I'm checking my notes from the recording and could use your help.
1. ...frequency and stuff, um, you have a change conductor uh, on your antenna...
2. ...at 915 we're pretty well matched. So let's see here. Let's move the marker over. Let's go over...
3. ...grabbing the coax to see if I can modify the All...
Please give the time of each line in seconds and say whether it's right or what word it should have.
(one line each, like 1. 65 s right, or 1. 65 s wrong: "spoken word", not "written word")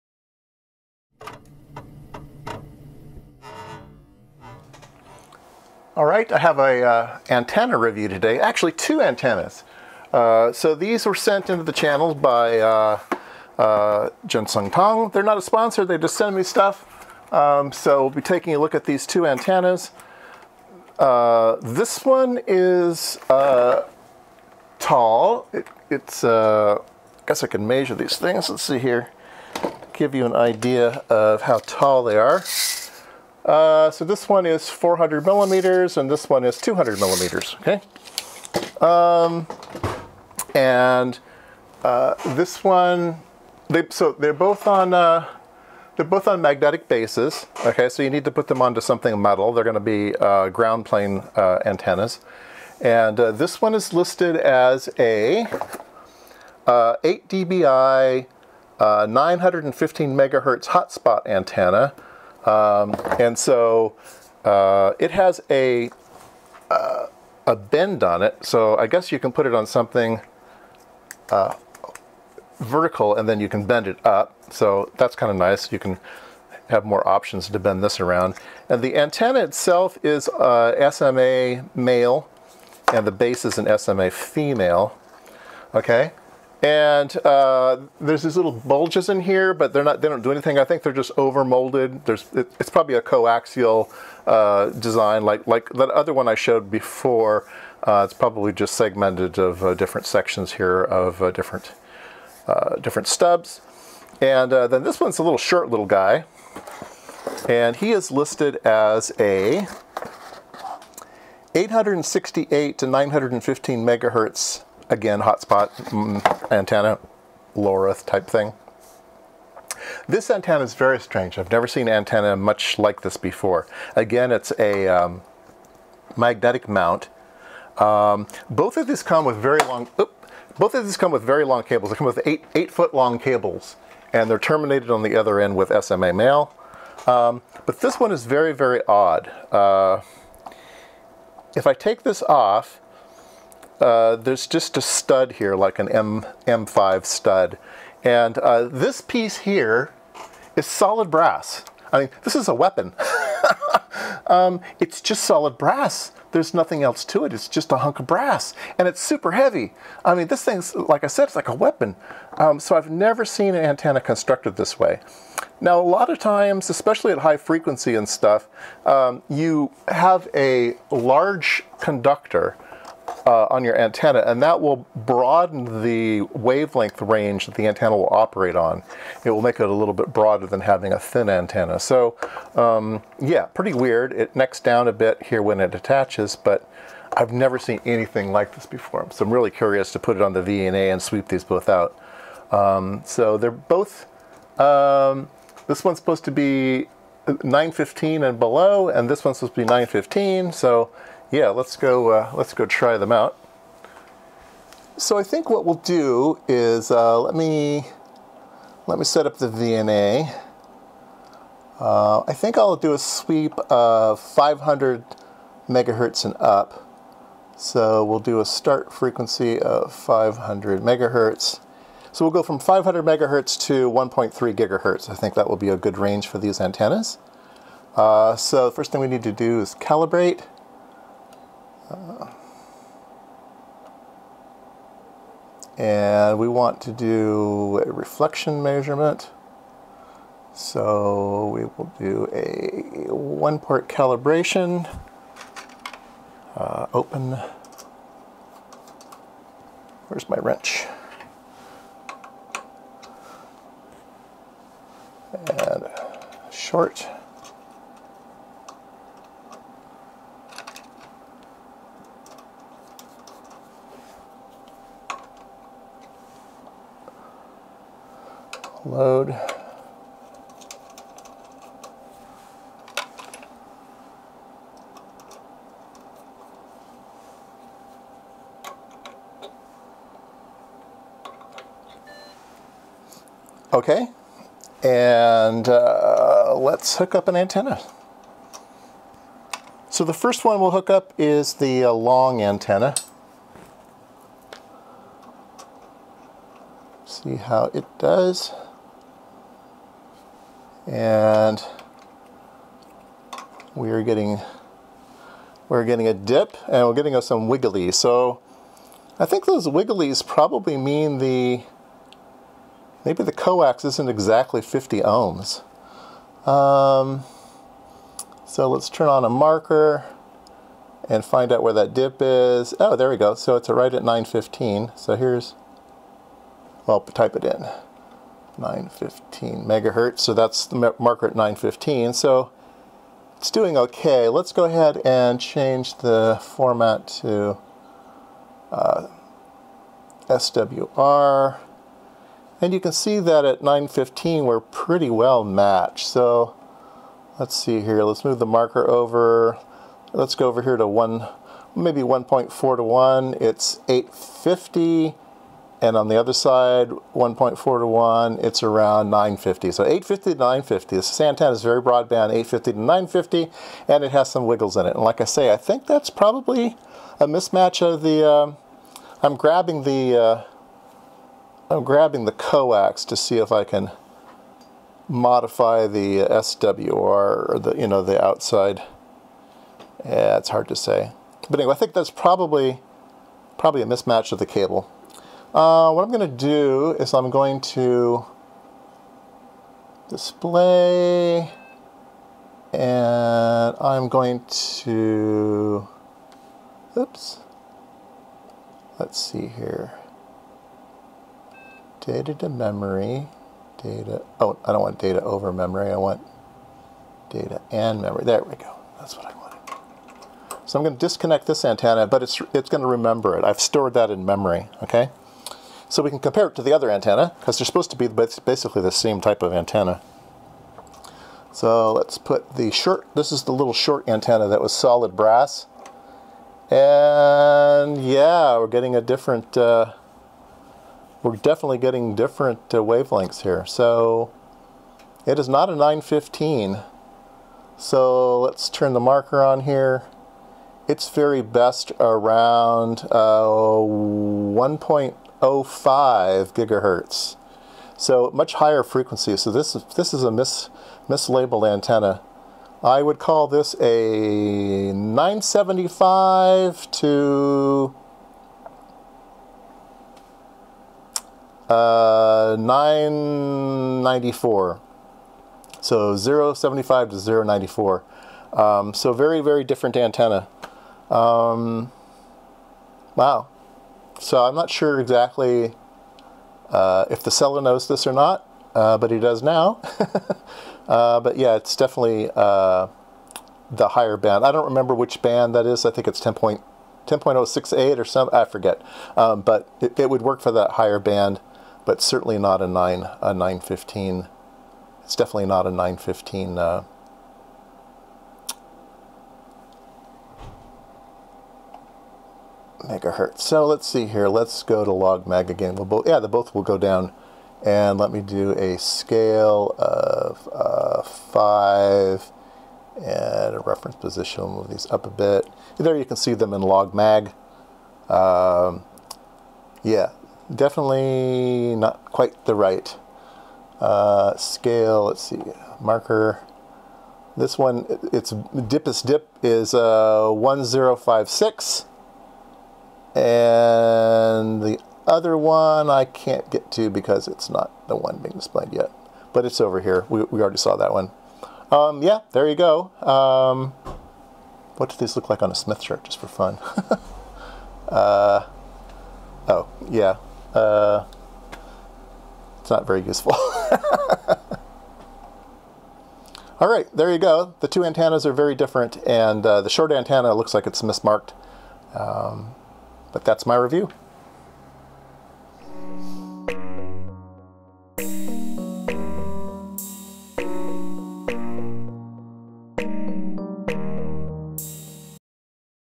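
1. 167 s wrong: "large", not "change"
2. 343 s right
3. 371 s wrong: "SWR", not "All".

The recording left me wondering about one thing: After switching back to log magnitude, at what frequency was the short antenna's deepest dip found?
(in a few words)
1056.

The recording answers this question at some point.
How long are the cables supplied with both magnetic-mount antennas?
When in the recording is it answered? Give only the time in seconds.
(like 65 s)
132 s.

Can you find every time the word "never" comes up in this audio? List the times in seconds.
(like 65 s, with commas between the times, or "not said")
121 s, 162 s, 187 s.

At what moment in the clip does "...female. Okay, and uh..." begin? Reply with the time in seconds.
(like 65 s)
84 s.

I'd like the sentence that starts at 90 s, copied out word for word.
I think they're just over molded.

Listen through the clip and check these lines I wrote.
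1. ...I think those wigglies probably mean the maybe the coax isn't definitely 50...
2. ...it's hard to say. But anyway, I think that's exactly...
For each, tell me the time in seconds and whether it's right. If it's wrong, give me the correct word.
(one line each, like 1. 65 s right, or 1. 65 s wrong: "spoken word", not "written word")
1. 309 s wrong: "exactly", not "definitely"
2. 380 s wrong: "probably", not "exactly".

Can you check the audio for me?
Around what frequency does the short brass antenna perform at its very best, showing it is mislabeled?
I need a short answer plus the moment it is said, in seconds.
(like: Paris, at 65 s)
1.1 gigahertz, at 443 s.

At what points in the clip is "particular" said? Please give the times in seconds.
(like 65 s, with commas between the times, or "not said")
not said.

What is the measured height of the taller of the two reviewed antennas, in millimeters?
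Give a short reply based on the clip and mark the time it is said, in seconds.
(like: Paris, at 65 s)
400 millimeters, at 34 s.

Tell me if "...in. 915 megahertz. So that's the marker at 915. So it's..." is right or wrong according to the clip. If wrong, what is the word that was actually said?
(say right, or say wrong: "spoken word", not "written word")
right.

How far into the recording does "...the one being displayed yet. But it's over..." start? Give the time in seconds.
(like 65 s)
537 s.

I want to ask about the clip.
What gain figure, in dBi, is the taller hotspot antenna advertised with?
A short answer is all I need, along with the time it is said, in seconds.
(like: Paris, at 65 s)
8 dBi, at 56 s.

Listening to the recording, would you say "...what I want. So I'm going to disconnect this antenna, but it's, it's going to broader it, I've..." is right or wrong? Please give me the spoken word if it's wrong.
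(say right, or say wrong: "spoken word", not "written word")
wrong: "remember", not "broader".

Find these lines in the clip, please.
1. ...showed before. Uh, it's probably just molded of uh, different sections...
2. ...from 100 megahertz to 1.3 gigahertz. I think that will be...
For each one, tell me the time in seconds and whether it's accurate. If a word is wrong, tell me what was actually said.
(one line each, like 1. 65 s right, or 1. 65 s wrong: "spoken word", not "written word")
1. 96 s wrong: "segmented", not "molded"
2. 222 s wrong: "500", not "100".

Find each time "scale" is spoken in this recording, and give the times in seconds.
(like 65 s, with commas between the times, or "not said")
508 s, 524 s.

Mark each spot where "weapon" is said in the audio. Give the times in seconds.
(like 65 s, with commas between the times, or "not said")
152 s, 161 s.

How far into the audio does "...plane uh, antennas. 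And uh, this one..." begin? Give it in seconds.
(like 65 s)
50 s.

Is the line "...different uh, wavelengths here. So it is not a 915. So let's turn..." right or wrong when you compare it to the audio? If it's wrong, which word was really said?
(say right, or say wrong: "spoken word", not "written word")
right.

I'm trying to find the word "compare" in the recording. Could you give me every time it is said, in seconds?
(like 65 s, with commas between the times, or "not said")
416 s.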